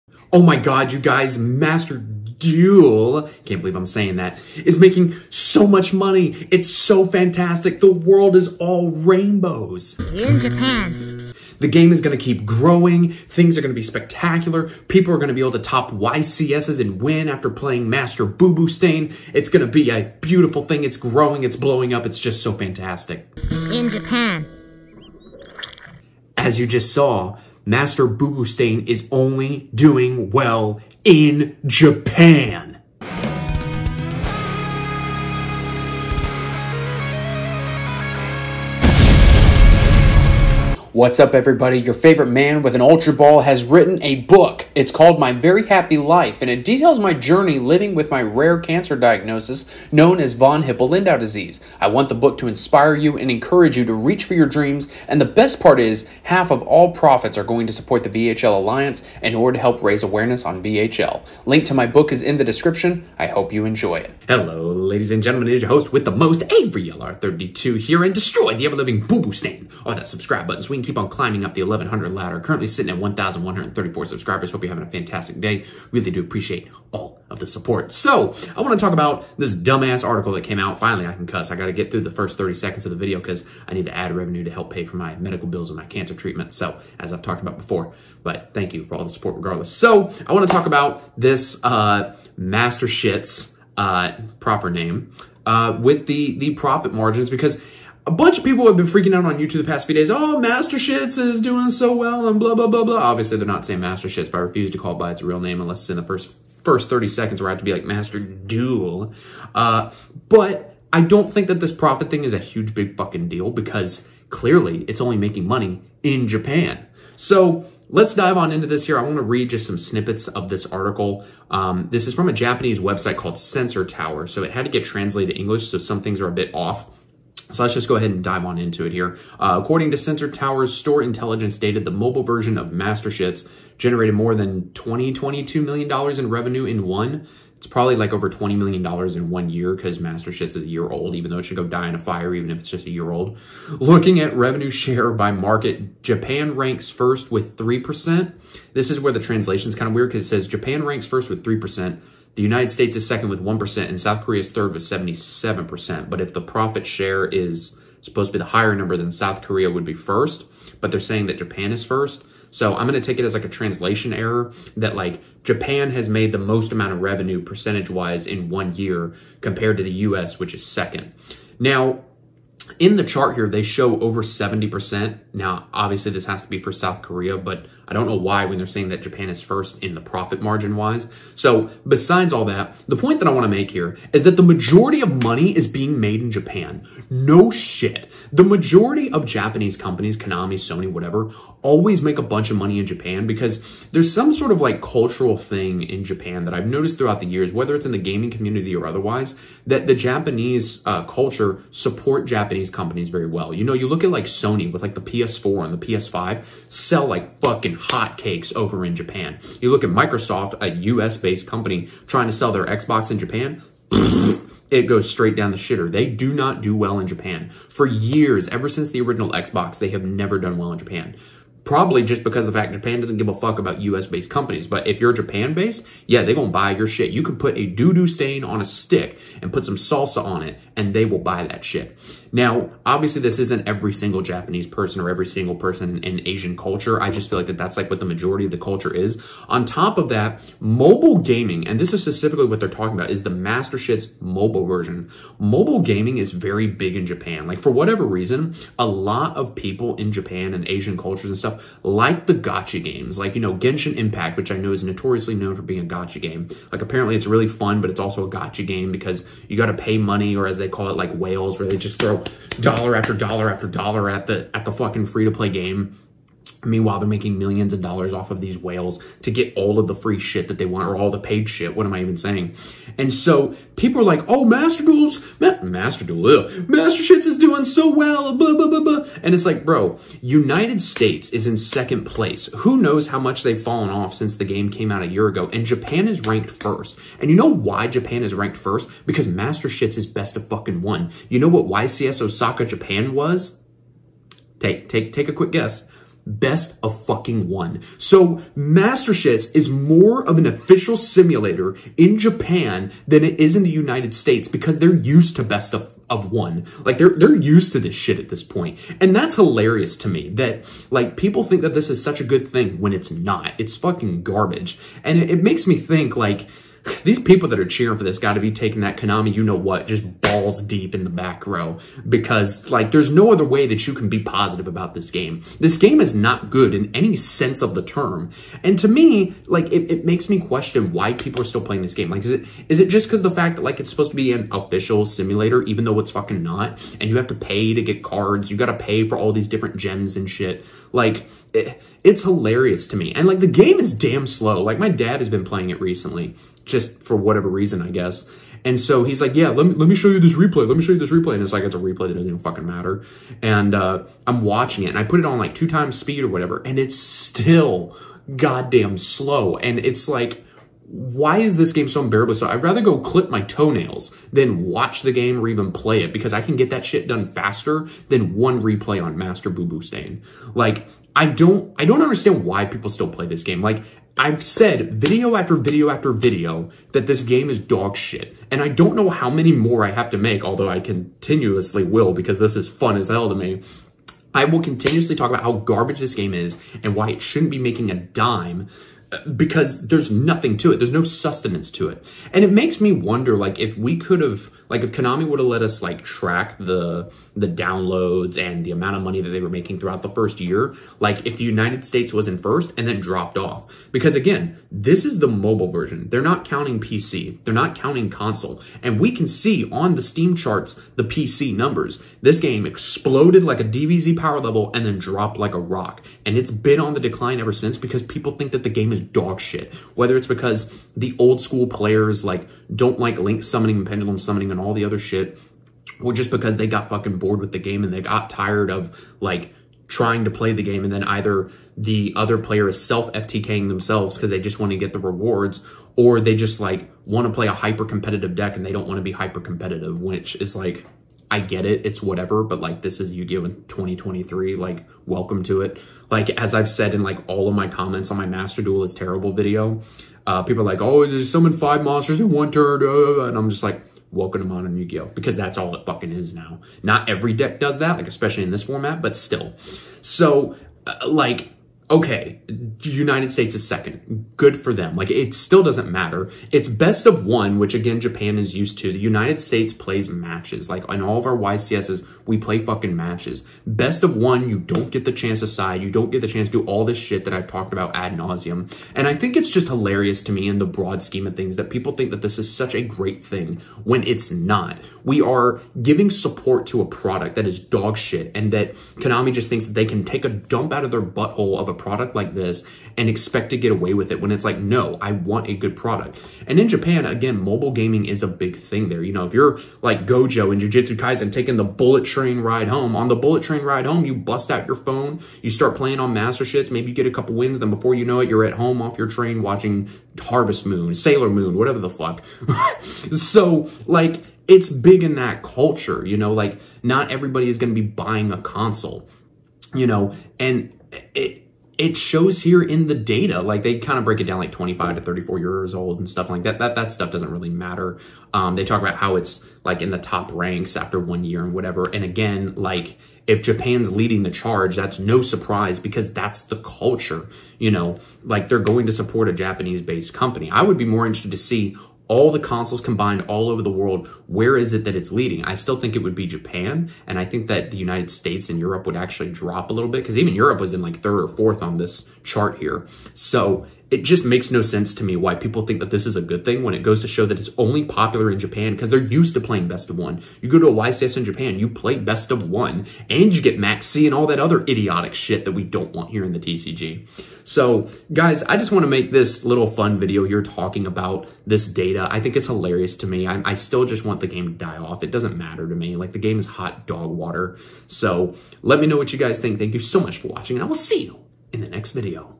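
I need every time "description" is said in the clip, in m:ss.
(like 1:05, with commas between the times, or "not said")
1:02.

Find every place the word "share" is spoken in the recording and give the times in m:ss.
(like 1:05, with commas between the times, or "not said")
2:24, 2:36.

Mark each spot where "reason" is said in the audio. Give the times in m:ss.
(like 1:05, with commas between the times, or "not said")
4:08, 5:47.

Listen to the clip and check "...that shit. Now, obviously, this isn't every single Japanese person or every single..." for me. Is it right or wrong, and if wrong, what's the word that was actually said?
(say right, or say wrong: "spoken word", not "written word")
right.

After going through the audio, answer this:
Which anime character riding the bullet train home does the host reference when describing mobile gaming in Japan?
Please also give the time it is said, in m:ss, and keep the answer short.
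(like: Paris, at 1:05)
Gojo, at 8:20.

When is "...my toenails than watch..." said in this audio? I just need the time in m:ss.
6:03.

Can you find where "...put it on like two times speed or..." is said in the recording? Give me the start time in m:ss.
5:55.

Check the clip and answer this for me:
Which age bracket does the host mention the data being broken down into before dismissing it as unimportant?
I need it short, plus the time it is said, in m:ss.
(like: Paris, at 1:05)
25 to 34, at 8:44.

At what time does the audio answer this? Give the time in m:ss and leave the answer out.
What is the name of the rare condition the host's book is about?
0:50.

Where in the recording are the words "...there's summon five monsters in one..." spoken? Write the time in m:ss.
7:31.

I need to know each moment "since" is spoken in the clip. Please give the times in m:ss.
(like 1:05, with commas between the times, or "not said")
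3:38, 4:44, 6:57.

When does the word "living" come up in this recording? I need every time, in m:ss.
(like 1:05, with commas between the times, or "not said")
0:47, 1:08.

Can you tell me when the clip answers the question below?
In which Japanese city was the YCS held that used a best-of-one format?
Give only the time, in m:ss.
4:52.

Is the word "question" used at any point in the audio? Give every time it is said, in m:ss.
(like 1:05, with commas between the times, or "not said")
5:30.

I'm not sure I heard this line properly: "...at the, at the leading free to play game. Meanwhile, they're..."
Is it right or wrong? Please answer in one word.
wrong.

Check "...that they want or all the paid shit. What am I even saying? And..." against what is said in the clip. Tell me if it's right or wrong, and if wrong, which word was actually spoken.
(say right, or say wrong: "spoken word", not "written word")
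right.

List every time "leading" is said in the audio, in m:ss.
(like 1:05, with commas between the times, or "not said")
8:53, 9:05.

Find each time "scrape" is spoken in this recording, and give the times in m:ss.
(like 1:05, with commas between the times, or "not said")
not said.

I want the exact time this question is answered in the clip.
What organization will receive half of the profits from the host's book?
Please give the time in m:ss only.
0:58.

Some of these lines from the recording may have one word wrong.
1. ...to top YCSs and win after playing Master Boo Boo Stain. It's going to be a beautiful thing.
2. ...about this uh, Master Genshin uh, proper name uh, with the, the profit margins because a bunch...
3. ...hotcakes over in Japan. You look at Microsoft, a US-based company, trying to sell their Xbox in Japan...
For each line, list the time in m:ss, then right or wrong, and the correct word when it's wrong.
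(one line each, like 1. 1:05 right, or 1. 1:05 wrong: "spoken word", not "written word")
1. 0:15 right
2. 1:30 wrong: "Shits", not "Genshin"
3. 3:27 right.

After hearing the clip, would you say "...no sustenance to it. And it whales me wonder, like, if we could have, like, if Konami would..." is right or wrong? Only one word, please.
wrong.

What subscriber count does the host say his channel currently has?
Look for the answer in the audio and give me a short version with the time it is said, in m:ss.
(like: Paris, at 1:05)
1,134, at 1:12.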